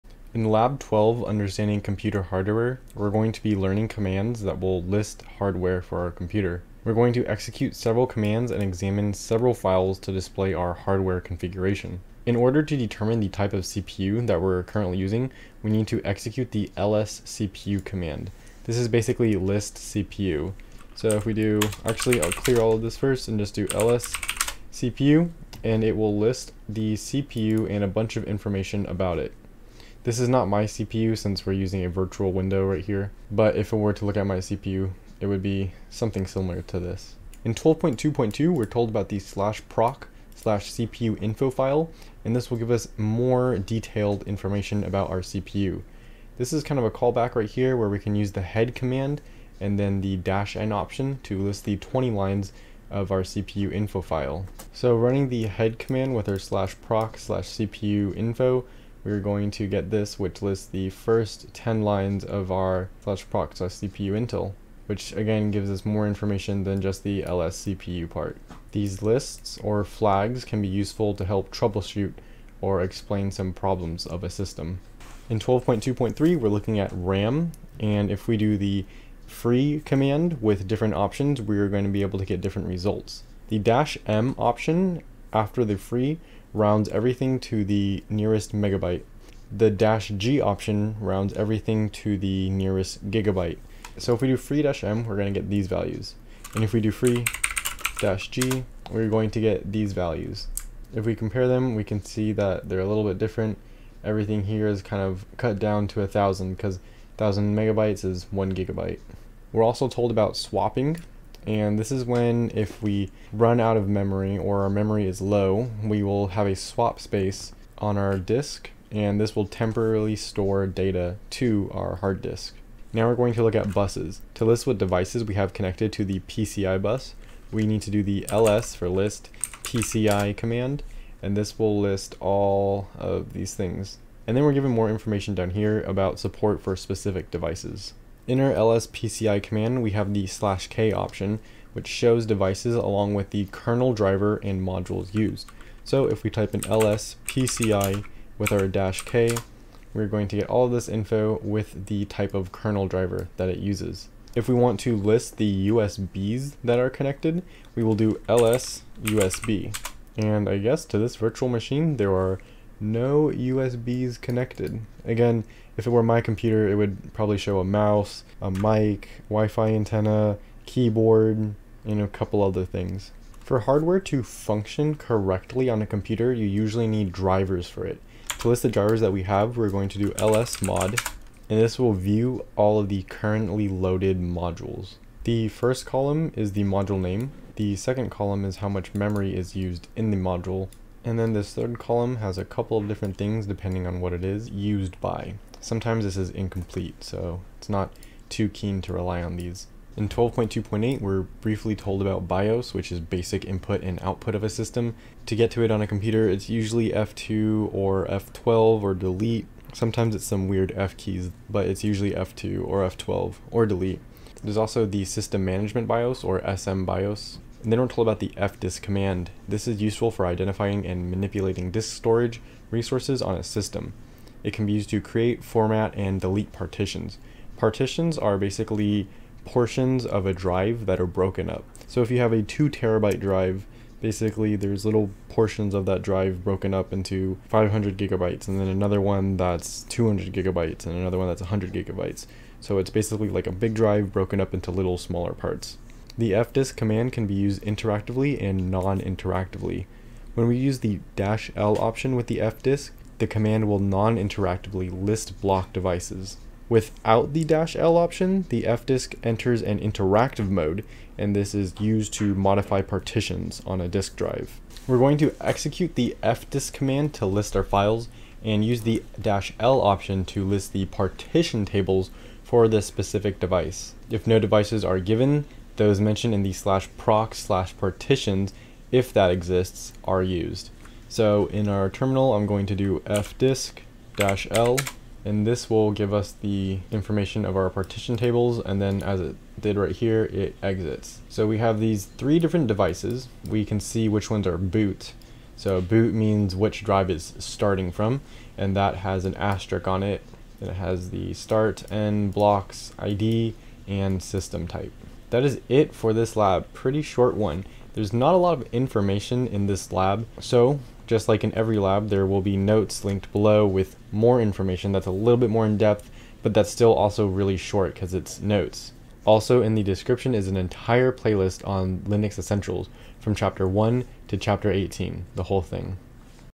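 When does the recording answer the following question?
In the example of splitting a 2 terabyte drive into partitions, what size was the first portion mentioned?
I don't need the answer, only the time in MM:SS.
03:57.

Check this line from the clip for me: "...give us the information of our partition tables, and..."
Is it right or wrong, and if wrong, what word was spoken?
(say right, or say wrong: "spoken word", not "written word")
right.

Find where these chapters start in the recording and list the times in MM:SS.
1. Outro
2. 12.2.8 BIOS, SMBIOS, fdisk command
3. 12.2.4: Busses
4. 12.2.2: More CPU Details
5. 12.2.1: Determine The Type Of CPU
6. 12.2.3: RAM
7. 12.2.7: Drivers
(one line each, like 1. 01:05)
1. 05:04
2. 03:19
3. 02:01
4. 00:36
5. 00:11
6. 01:14
7. 02:52.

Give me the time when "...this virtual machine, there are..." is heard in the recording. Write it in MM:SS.
02:40.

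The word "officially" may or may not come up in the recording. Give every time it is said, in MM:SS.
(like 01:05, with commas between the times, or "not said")
not said.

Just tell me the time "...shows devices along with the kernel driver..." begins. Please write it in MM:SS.
02:21.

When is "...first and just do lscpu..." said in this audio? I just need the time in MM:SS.
00:22.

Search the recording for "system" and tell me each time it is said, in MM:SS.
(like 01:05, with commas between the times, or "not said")
01:14, 03:24, 03:35, 03:43, 05:04.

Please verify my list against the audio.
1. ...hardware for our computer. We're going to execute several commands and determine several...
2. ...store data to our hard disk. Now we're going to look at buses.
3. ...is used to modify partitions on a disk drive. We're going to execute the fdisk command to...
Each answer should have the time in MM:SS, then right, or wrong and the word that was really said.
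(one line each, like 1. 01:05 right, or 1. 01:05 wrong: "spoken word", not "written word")
1. 00:05 wrong: "examine", not "determine"
2. 02:00 right
3. 04:21 right.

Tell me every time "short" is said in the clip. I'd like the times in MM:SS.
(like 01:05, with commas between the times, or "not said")
05:07, 05:17.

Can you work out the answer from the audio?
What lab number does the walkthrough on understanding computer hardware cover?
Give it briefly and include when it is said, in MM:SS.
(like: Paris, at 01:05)
12, at 00:00.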